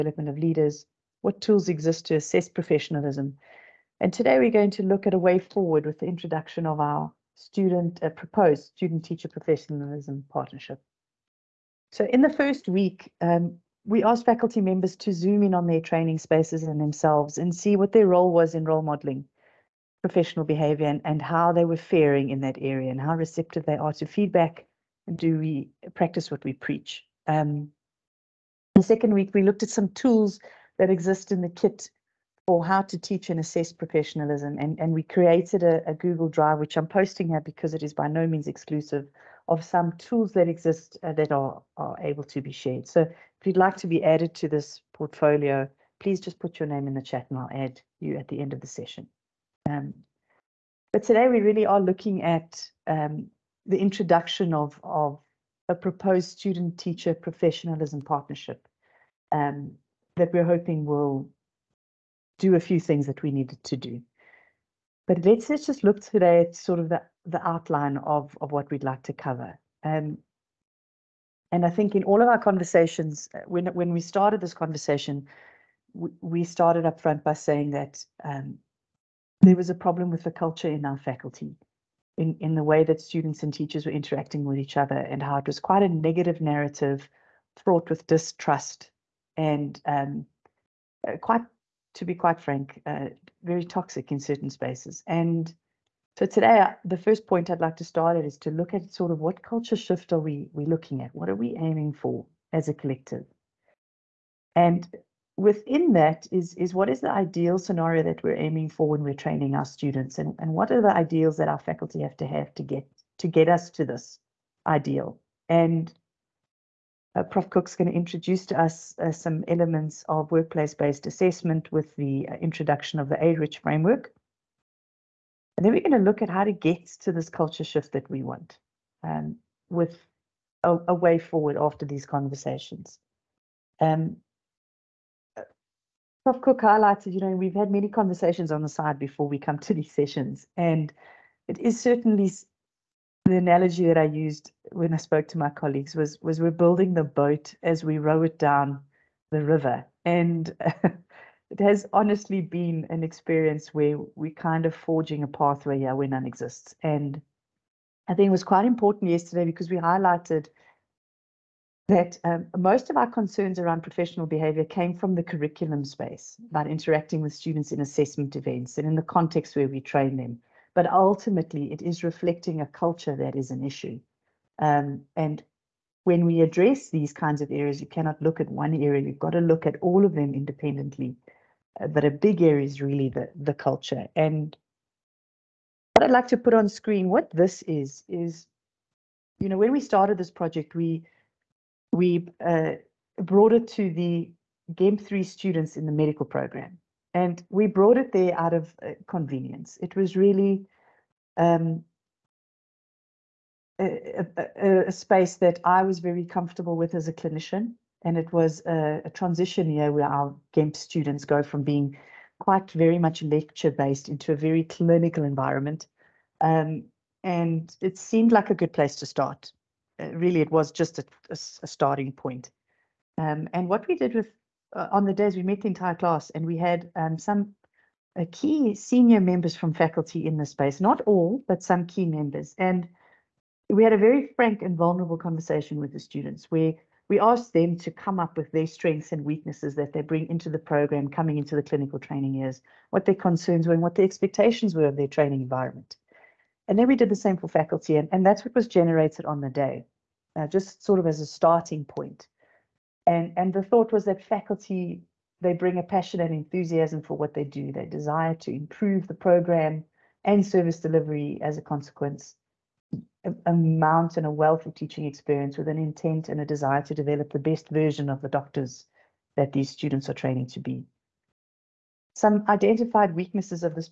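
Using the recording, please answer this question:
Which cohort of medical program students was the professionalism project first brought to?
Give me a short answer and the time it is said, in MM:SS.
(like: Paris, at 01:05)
GEMP 3, at 03:14.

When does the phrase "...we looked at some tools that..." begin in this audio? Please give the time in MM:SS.
00:29.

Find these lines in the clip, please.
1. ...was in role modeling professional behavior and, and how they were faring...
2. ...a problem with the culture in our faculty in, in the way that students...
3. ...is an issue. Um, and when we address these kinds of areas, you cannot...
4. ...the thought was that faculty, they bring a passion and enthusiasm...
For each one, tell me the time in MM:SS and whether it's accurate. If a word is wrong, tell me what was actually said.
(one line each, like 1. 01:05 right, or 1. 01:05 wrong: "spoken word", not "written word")
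1. 00:18 right
2. 01:19 right
3. 02:53 right
4. 04:13 right.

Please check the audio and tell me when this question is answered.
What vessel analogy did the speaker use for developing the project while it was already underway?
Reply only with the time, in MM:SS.
02:26.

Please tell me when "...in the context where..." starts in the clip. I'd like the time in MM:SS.
02:48.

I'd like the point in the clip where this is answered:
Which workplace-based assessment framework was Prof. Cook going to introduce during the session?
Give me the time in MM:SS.
02:03.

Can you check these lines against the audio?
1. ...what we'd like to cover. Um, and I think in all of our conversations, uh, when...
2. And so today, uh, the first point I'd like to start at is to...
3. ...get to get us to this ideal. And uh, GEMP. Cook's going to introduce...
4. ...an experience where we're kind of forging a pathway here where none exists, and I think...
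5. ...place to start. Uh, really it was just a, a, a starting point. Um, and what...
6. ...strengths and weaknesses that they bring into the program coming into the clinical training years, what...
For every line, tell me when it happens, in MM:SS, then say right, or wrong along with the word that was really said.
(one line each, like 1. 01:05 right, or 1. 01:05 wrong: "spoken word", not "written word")
1. 01:08 right
2. 01:35 right
3. 01:52 wrong: "Prof", not "GEMP"
4. 02:32 right
5. 03:38 right
6. 03:58 right.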